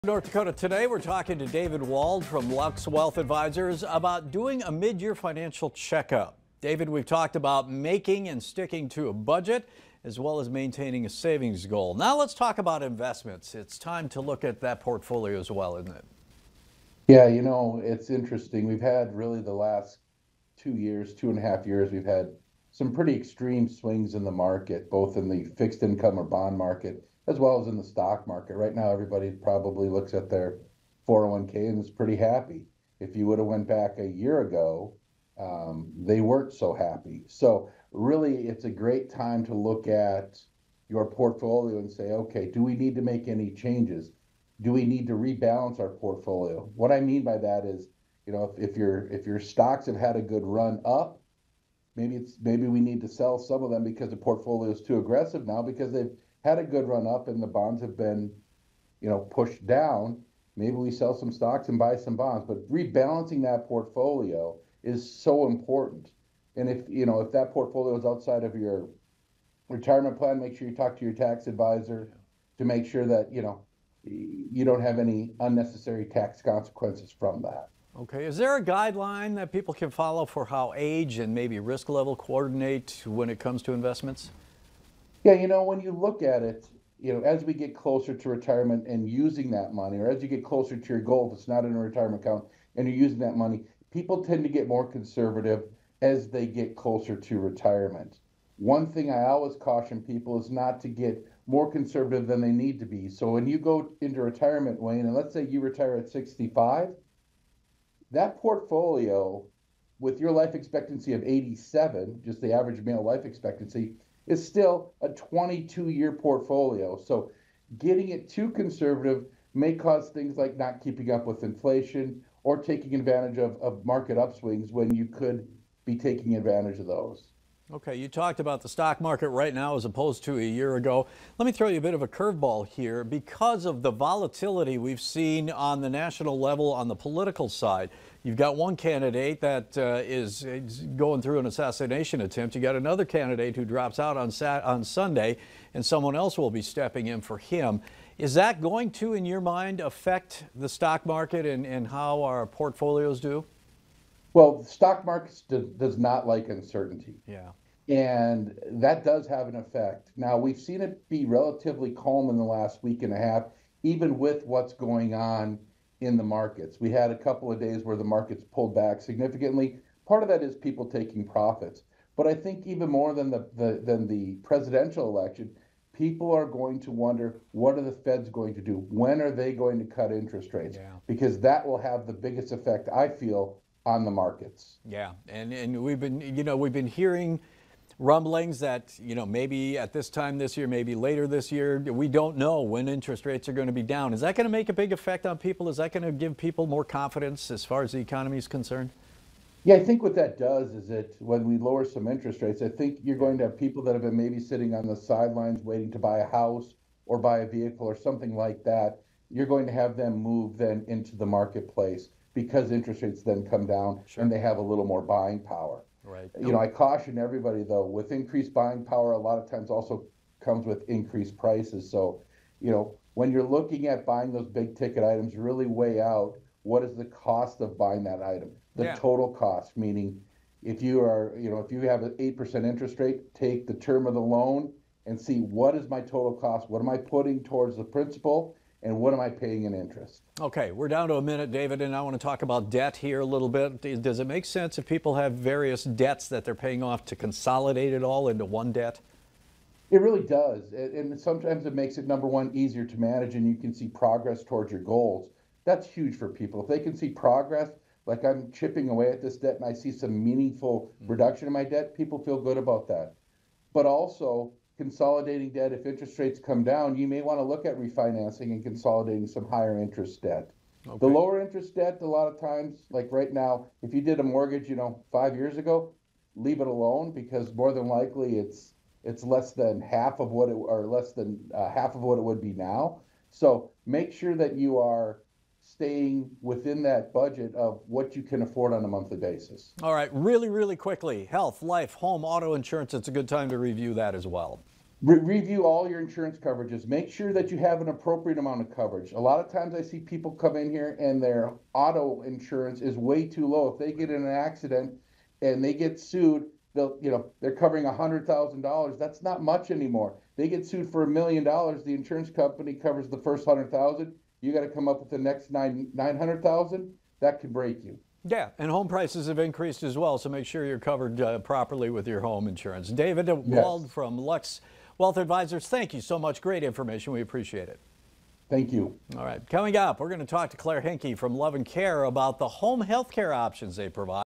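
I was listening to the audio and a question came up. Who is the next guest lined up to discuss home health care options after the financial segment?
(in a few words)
Claire Henke.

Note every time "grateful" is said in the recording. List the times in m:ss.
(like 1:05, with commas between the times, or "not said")
not said.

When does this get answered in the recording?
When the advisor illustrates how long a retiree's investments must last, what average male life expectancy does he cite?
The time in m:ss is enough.
1:51.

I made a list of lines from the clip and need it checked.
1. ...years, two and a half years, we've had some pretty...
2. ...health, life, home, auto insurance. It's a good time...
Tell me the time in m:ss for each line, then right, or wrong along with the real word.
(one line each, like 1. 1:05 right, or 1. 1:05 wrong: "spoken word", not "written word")
1. 0:20 right
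2. 4:51 right.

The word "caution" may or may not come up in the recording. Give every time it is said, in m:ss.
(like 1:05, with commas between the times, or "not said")
1:39, 3:36.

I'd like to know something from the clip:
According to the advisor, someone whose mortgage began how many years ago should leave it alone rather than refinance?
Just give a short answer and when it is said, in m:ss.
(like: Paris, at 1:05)
5, at 4:35.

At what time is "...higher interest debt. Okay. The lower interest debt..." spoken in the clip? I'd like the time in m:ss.
4:29.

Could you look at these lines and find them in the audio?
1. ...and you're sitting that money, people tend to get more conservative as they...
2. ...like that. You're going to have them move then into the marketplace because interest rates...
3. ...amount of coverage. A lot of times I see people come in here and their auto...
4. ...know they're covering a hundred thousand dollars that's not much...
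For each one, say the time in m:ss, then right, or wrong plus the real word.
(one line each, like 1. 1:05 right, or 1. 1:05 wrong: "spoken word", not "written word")
1. 1:32 wrong: "using", not "sitting"
2. 3:28 right
3. 4:58 right
4. 5:07 right.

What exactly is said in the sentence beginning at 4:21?
reduction in my debt, people feel good about that.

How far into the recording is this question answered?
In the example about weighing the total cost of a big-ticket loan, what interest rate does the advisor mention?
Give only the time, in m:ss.
3:52.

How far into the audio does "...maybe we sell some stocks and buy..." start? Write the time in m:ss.
1:00.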